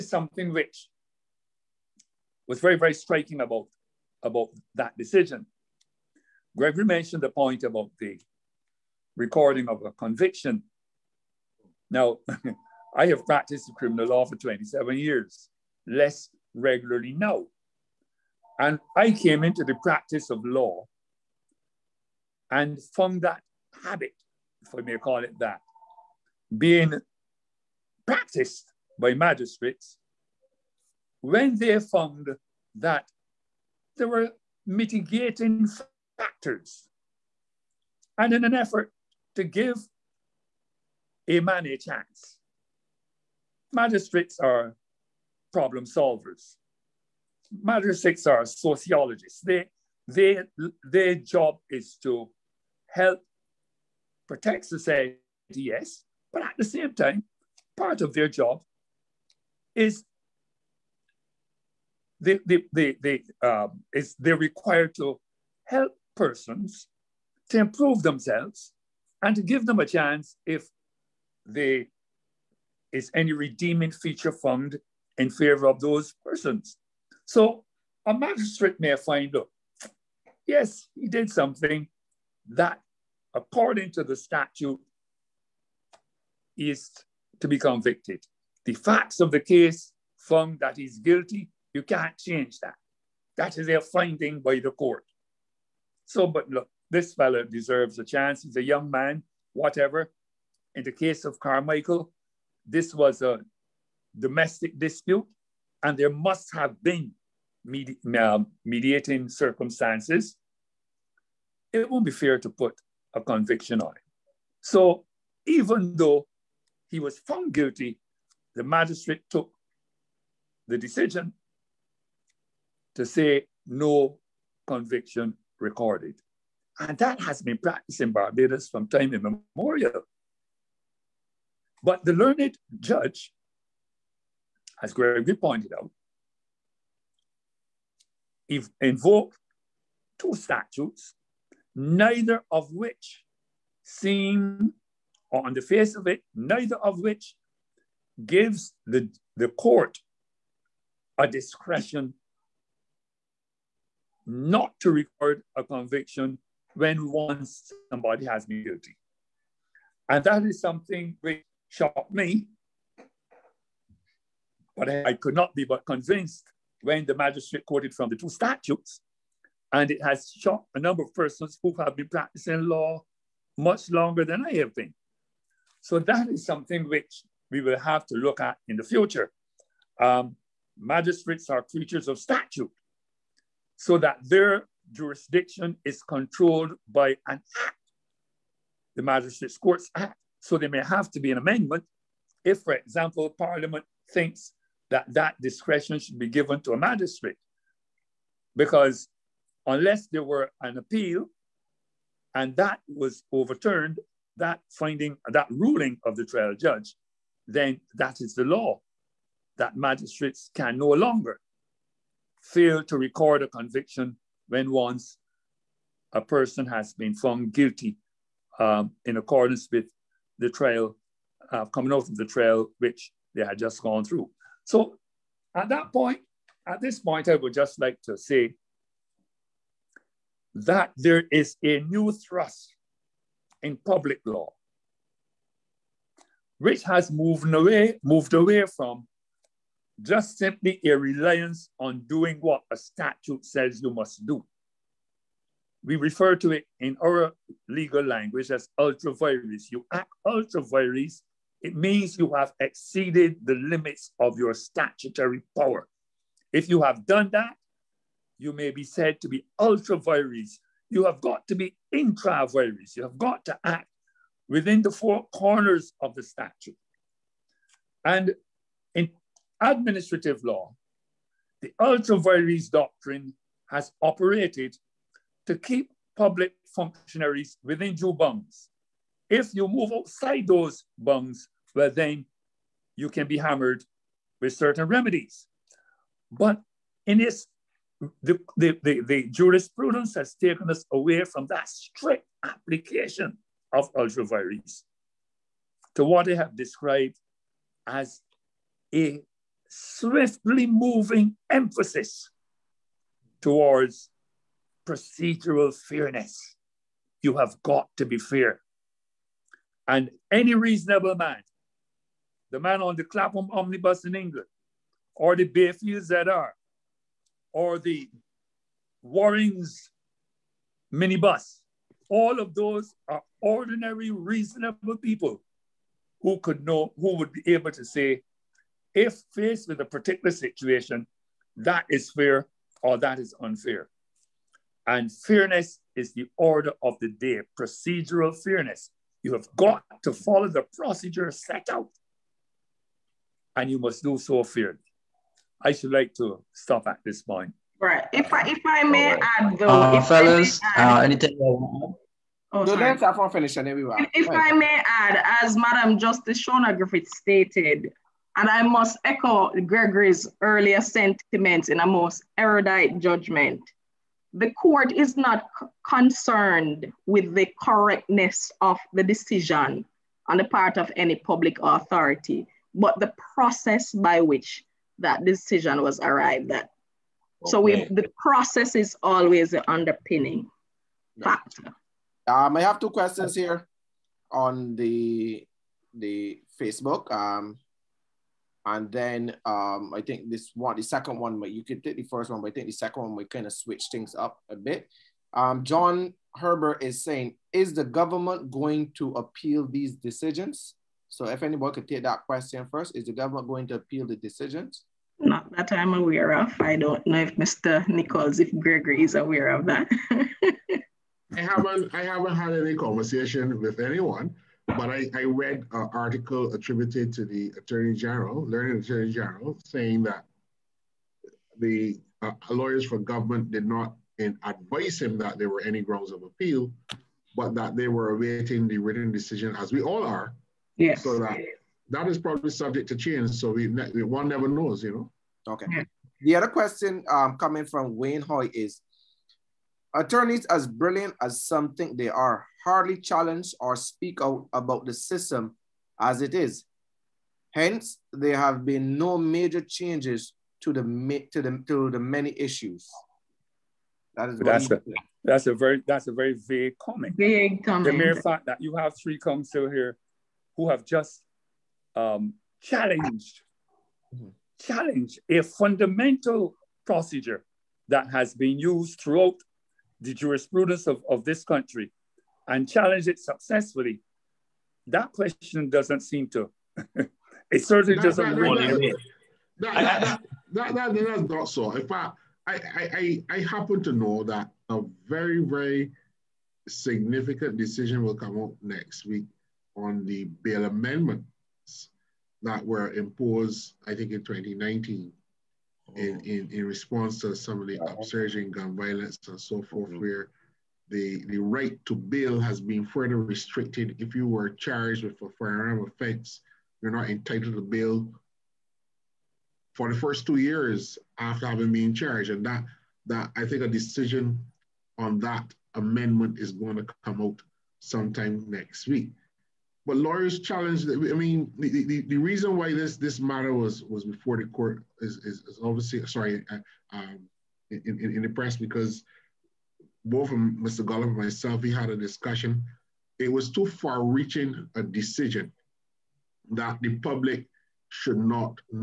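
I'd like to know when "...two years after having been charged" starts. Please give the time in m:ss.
8:30.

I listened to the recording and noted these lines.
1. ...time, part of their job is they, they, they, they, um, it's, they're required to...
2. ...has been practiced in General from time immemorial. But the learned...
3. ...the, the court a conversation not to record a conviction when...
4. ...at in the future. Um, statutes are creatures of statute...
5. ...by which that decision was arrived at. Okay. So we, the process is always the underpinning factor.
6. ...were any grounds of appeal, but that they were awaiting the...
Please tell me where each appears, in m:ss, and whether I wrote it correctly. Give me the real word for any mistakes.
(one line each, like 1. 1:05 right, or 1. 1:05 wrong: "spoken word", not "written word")
1. 0:56 right
2. 2:07 wrong: "Barbados", not "General"
3. 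2:28 wrong: "discretion", not "conversation"
4. 2:58 wrong: "magistrates", not "statutes"
5. 6:13 right
6. 7:05 right.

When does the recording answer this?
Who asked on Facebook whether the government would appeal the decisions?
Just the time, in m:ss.
6:35.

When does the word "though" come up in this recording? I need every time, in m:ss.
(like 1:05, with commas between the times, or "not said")
1:55, 5:49.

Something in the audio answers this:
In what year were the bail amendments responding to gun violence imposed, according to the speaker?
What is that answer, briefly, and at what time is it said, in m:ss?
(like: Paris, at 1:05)
2019, at 8:14.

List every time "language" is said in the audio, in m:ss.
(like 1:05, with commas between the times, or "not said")
4:08.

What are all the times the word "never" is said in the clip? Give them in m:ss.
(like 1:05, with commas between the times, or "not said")
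7:14.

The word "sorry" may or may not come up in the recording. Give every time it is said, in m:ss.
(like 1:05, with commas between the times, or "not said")
5:52, 8:46.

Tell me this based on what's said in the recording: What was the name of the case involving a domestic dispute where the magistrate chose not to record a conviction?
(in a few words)
Carmichael.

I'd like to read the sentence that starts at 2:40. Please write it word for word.
And that is something which shocked me.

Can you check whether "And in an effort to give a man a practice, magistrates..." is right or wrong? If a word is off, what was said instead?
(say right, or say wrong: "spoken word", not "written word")
wrong: "chance", not "practice".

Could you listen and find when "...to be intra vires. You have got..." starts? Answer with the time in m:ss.
4:21.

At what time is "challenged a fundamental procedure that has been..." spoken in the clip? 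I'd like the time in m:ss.
7:44.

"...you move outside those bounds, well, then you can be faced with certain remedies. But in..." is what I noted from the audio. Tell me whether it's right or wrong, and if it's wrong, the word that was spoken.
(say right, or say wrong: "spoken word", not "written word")
wrong: "hammered", not "faced".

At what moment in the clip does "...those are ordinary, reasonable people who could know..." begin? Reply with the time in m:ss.
5:22.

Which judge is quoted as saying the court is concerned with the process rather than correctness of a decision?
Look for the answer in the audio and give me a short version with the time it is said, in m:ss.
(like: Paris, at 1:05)
Shona Griffith, at 5:56.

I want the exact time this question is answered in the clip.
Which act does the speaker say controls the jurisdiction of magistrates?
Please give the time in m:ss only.
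3:08.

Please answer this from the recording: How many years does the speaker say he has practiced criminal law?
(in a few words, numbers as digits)
27.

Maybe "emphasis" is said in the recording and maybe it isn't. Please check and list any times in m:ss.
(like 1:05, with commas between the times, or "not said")
5:01.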